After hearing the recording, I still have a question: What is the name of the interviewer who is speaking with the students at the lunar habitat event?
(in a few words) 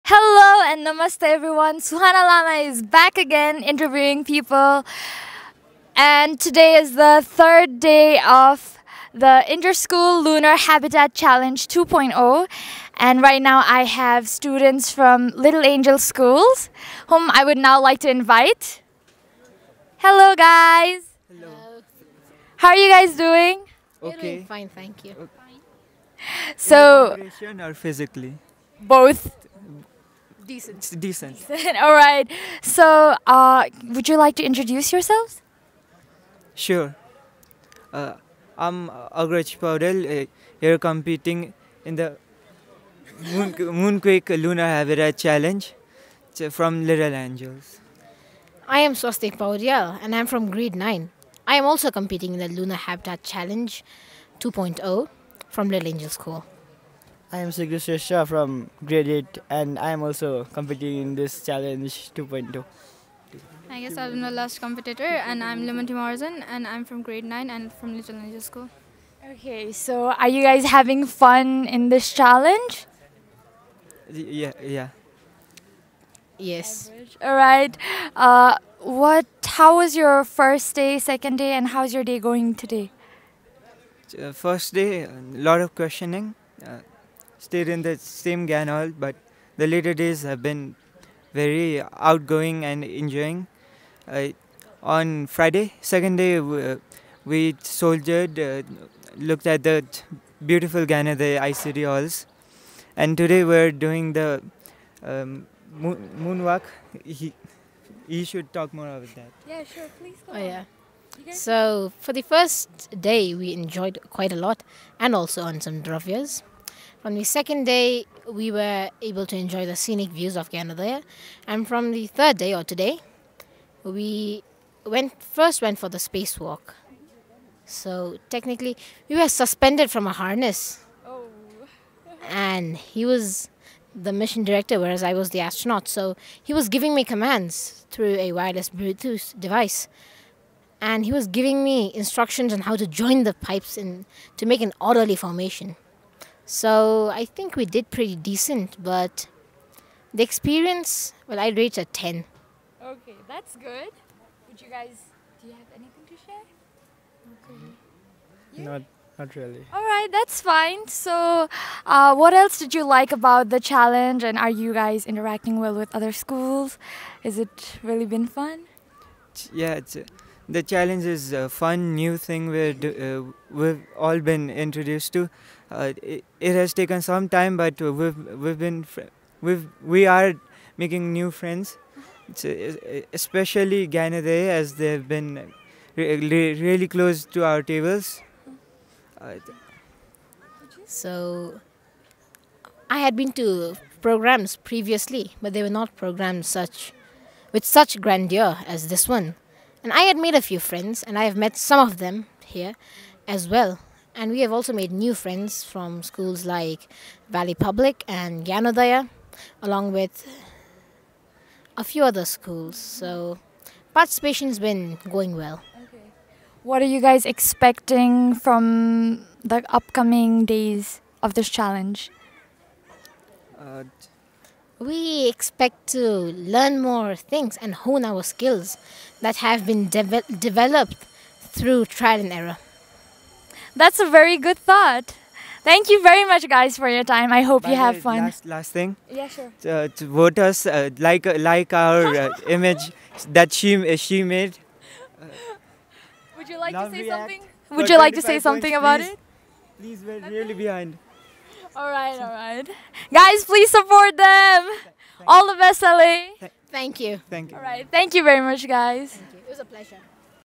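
Suhana Lama.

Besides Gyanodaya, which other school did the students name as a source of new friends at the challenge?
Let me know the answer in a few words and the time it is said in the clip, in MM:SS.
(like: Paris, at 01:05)
Valley Public, at 03:27.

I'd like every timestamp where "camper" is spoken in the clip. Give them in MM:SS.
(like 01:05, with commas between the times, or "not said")
not said.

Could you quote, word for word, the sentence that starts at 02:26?
So I think we did pretty decent, but the experience, well, I'd rate a 10.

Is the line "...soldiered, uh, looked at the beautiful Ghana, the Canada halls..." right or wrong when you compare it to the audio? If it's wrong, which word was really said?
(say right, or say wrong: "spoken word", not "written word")
wrong: "ICD", not "Canada".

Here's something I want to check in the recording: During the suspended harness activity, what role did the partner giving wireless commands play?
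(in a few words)
mission director.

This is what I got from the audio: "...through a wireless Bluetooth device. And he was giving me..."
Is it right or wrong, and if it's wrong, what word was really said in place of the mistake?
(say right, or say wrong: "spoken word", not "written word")
right.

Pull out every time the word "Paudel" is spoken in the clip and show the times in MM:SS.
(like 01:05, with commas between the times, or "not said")
00:39, 00:49.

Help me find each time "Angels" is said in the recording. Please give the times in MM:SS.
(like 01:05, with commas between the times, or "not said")
00:15, 00:47, 00:55, 01:08.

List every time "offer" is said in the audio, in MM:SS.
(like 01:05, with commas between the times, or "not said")
not said.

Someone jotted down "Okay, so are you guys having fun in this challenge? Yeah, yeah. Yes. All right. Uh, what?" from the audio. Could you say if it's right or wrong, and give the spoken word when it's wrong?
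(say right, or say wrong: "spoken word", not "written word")
right.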